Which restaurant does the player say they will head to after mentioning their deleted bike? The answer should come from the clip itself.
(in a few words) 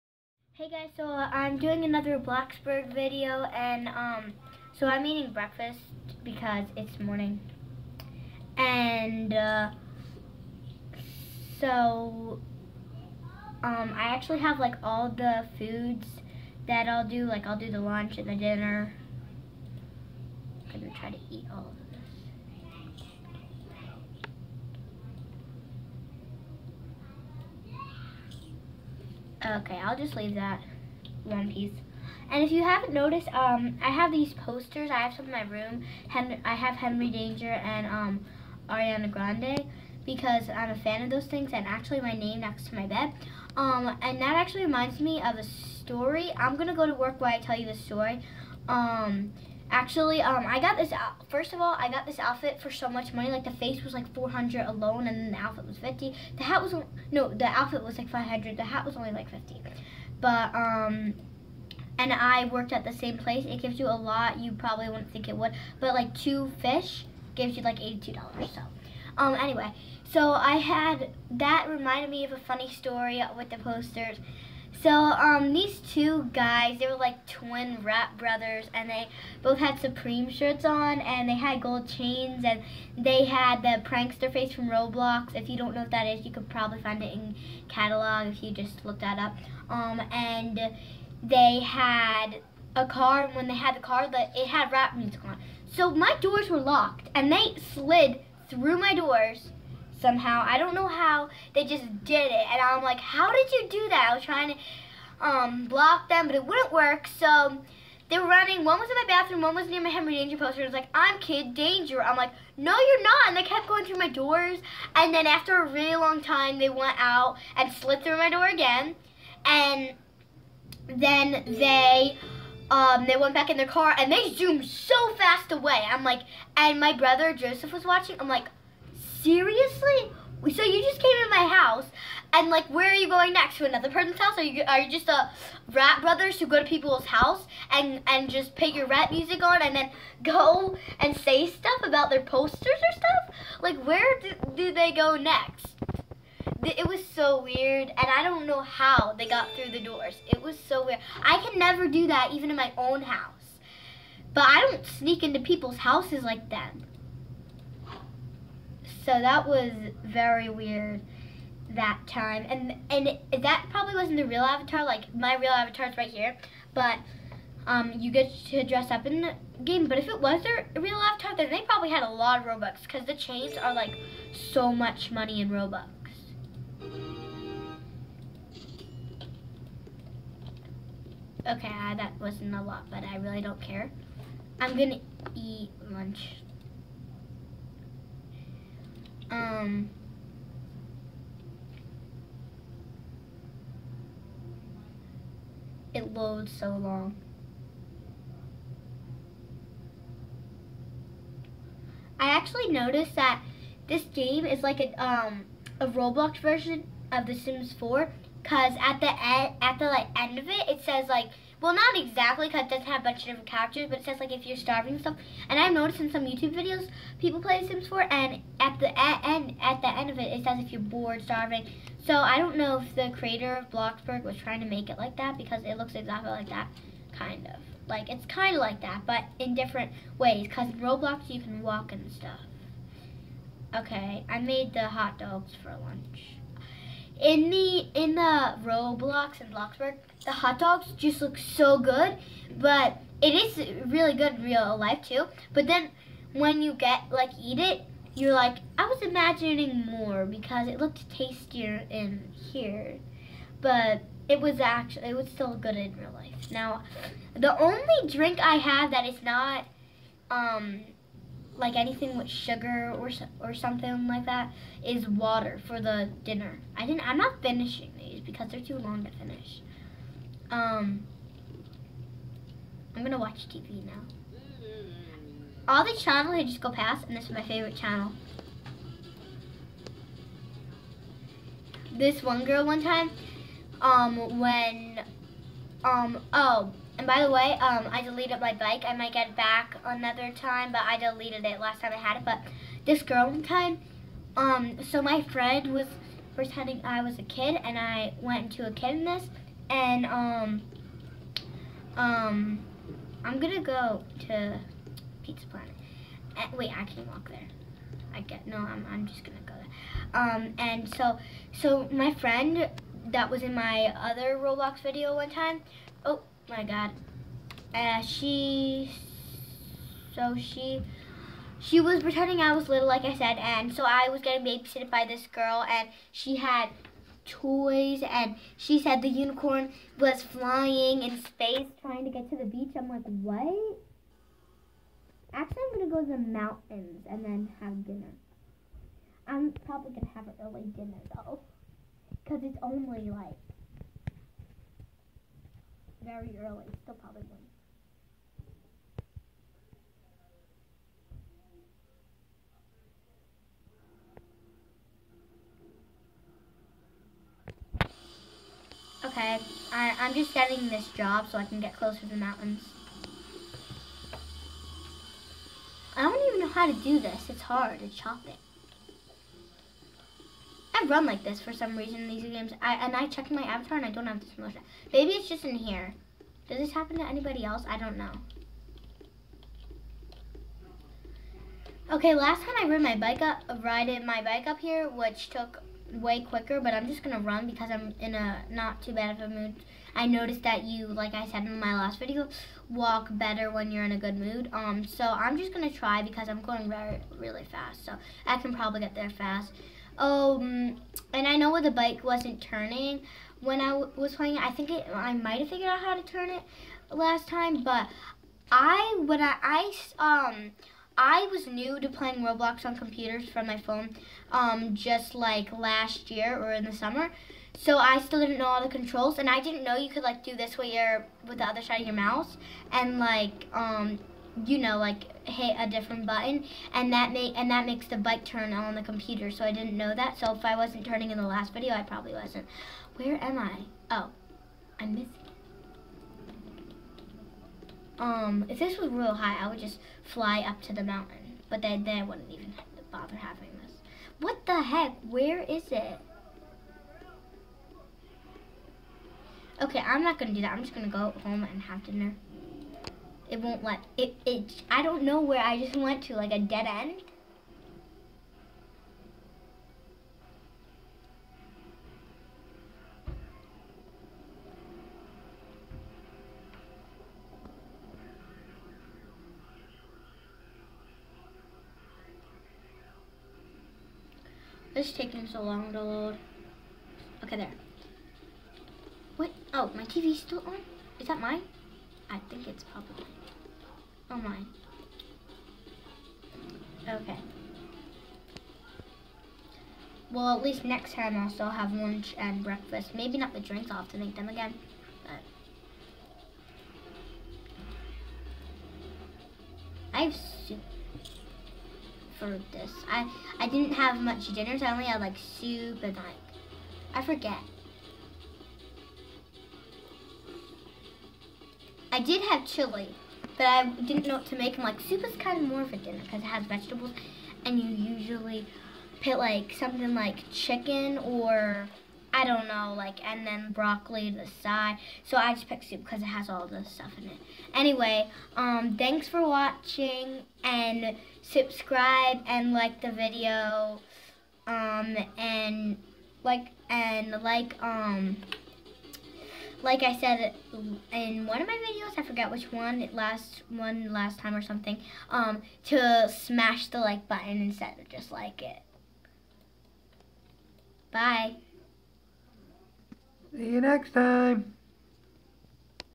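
Pizza Planet.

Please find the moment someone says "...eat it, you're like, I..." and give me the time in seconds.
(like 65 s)
247 s.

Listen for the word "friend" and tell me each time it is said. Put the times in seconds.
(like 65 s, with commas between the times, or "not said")
295 s, 312 s.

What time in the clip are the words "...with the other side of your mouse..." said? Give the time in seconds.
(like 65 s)
421 s.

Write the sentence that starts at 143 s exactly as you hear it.
Like, where do, do they go next?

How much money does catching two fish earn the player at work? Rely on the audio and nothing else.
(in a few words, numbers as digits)
$82.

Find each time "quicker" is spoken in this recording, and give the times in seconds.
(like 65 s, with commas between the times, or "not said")
386 s.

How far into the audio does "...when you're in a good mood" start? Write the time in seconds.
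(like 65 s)
393 s.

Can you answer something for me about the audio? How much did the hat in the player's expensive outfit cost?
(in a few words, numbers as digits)
50.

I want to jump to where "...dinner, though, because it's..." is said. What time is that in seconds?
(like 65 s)
340 s.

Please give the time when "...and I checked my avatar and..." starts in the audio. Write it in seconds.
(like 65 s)
372 s.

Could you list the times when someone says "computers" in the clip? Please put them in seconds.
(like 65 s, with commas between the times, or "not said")
412 s, 428 s.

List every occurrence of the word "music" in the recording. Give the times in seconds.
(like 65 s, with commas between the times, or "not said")
94 s, 139 s.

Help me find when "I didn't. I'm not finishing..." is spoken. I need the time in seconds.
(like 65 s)
266 s.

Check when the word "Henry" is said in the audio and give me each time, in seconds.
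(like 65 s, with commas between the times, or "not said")
36 s, 109 s.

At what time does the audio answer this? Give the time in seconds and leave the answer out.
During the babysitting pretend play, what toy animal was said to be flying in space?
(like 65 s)
329 s.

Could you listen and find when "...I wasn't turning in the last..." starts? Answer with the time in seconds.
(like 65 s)
430 s.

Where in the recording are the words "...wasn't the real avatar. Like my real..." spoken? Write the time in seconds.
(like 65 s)
163 s.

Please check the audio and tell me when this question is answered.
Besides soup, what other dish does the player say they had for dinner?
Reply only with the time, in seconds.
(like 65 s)
512 s.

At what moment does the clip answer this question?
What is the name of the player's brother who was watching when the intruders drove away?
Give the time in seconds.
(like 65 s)
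127 s.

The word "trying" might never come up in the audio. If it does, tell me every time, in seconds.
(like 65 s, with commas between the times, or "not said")
104 s, 224 s, 331 s.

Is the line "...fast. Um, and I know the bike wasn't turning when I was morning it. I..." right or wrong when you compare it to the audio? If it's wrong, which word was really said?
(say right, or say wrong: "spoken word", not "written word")
wrong: "playing", not "morning".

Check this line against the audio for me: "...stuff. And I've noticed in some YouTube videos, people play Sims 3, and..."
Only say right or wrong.
wrong.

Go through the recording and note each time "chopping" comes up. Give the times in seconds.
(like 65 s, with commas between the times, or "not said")
367 s.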